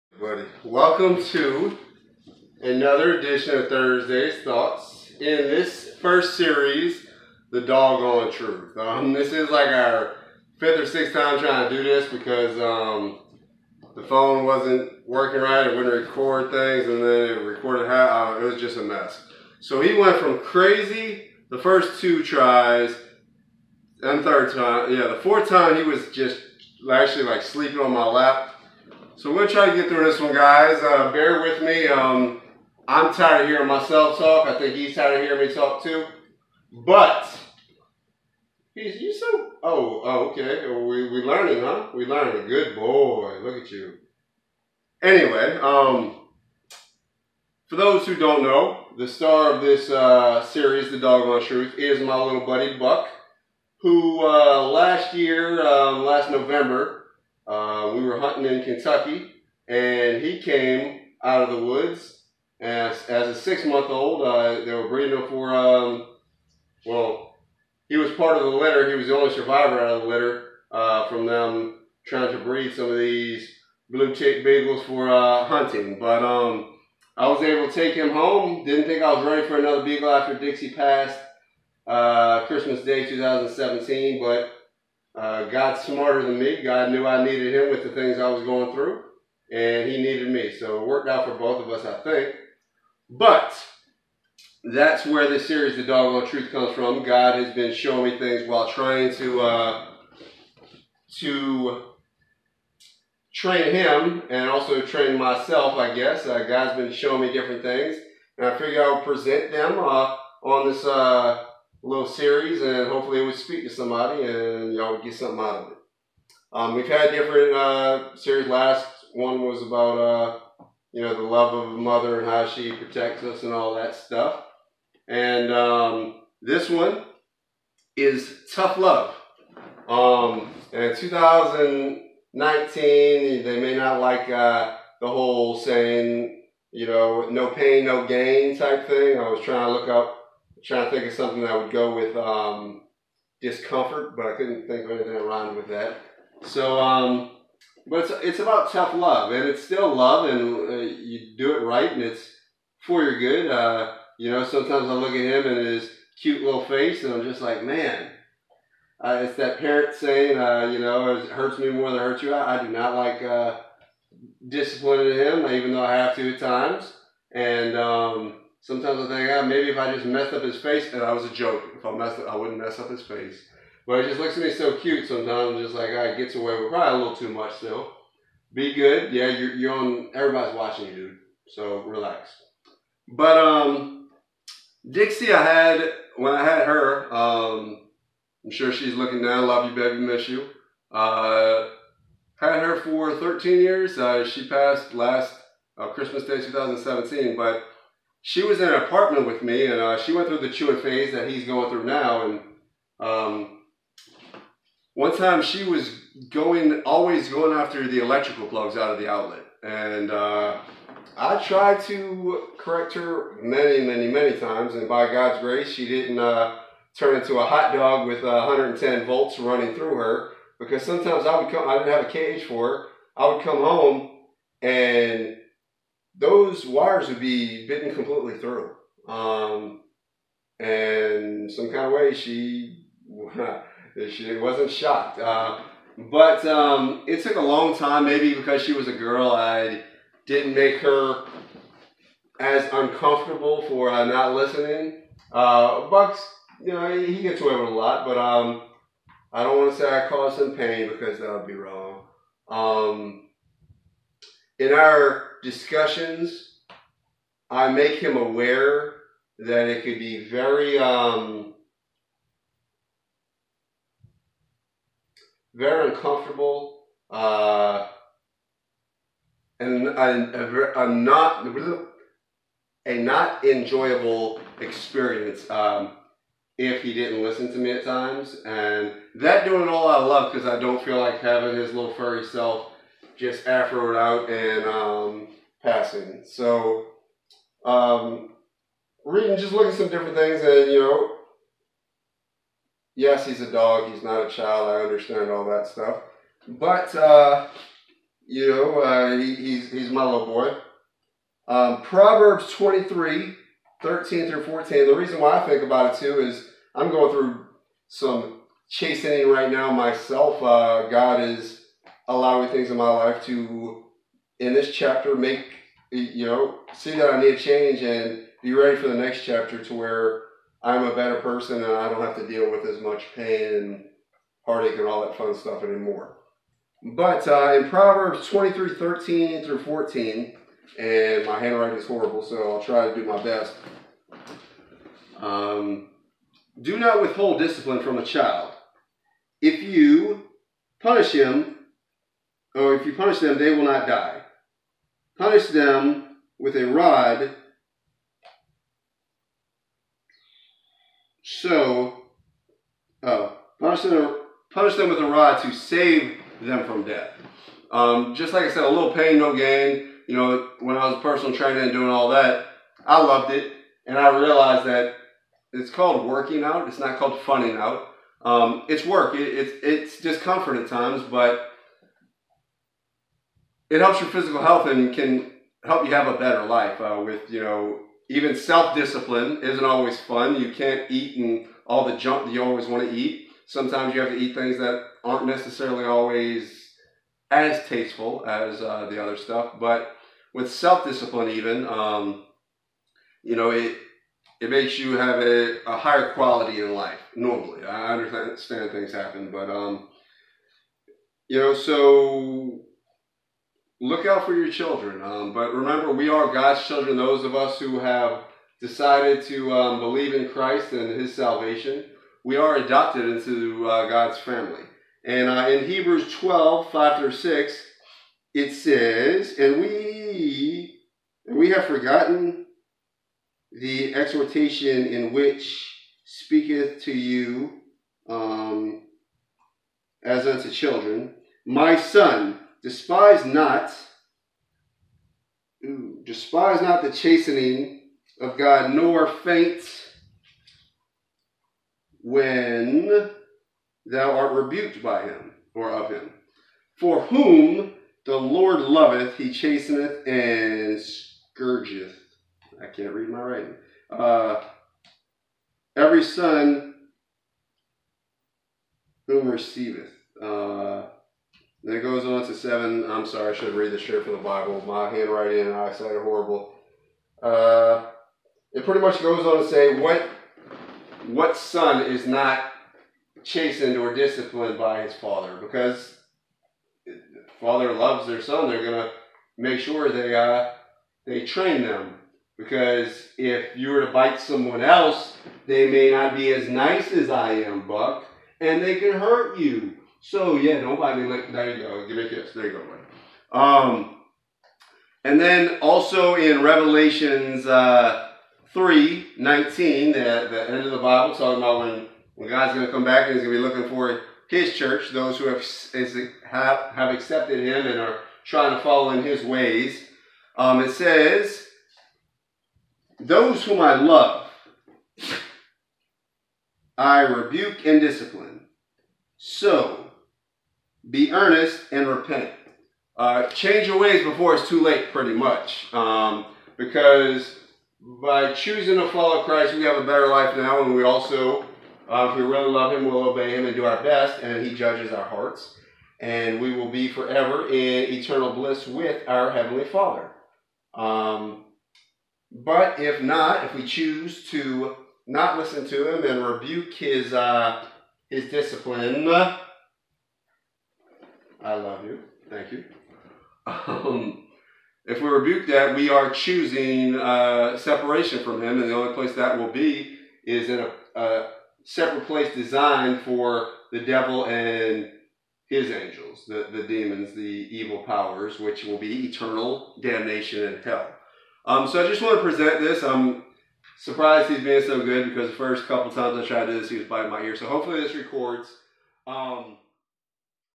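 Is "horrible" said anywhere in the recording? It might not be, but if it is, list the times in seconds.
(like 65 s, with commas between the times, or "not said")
331 s, 466 s.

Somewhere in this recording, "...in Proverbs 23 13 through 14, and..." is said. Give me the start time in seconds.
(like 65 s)
327 s.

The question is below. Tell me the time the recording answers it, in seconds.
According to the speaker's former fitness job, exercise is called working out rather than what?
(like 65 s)
367 s.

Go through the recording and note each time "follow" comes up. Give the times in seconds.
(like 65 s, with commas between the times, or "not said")
508 s, 528 s.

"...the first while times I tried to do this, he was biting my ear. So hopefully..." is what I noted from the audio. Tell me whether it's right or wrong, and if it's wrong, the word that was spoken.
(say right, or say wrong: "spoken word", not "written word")
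wrong: "couple", not "while".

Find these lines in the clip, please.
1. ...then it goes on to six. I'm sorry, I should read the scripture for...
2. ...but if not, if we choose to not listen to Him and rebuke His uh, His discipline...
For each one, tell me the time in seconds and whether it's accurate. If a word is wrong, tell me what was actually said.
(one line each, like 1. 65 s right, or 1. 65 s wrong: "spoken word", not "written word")
1. 461 s wrong: "seven", not "six"
2. 542 s right.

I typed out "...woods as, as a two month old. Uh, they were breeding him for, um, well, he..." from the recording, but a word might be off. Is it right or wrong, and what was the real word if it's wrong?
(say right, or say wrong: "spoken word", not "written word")
wrong: "six", not "two".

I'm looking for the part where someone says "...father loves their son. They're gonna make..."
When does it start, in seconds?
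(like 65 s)
477 s.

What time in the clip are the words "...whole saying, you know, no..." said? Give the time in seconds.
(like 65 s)
135 s.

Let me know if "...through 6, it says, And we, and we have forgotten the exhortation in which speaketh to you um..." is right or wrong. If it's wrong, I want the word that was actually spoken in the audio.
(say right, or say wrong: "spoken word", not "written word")
right.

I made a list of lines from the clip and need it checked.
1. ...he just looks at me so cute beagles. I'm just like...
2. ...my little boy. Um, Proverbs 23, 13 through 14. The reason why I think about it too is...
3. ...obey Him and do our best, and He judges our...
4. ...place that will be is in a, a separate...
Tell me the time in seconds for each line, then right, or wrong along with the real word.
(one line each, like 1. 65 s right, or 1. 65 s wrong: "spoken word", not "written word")
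1. 174 s wrong: "sometimes", not "beagles"
2. 299 s right
3. 533 s right
4. 558 s right.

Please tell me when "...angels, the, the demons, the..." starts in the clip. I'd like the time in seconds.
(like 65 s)
565 s.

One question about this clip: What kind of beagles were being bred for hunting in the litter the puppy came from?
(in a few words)
blue tick beagles.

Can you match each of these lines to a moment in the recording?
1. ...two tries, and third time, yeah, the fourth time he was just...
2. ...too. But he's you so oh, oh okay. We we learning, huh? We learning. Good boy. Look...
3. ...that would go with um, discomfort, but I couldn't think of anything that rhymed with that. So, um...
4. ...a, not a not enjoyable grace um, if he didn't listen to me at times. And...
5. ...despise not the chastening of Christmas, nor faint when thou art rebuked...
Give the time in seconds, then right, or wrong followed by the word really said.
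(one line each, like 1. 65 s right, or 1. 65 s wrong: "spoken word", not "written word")
1. 21 s right
2. 35 s right
3. 141 s right
4. 269 s wrong: "experience", not "grace"
5. 436 s wrong: "God", not "Christmas".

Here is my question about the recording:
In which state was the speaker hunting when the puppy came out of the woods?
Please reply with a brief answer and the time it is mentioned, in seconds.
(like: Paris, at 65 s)
Kentucky, at 58 s.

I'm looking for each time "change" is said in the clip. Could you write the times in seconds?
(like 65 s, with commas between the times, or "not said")
317 s, 523 s.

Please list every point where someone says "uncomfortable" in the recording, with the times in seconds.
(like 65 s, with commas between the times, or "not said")
242 s, 265 s.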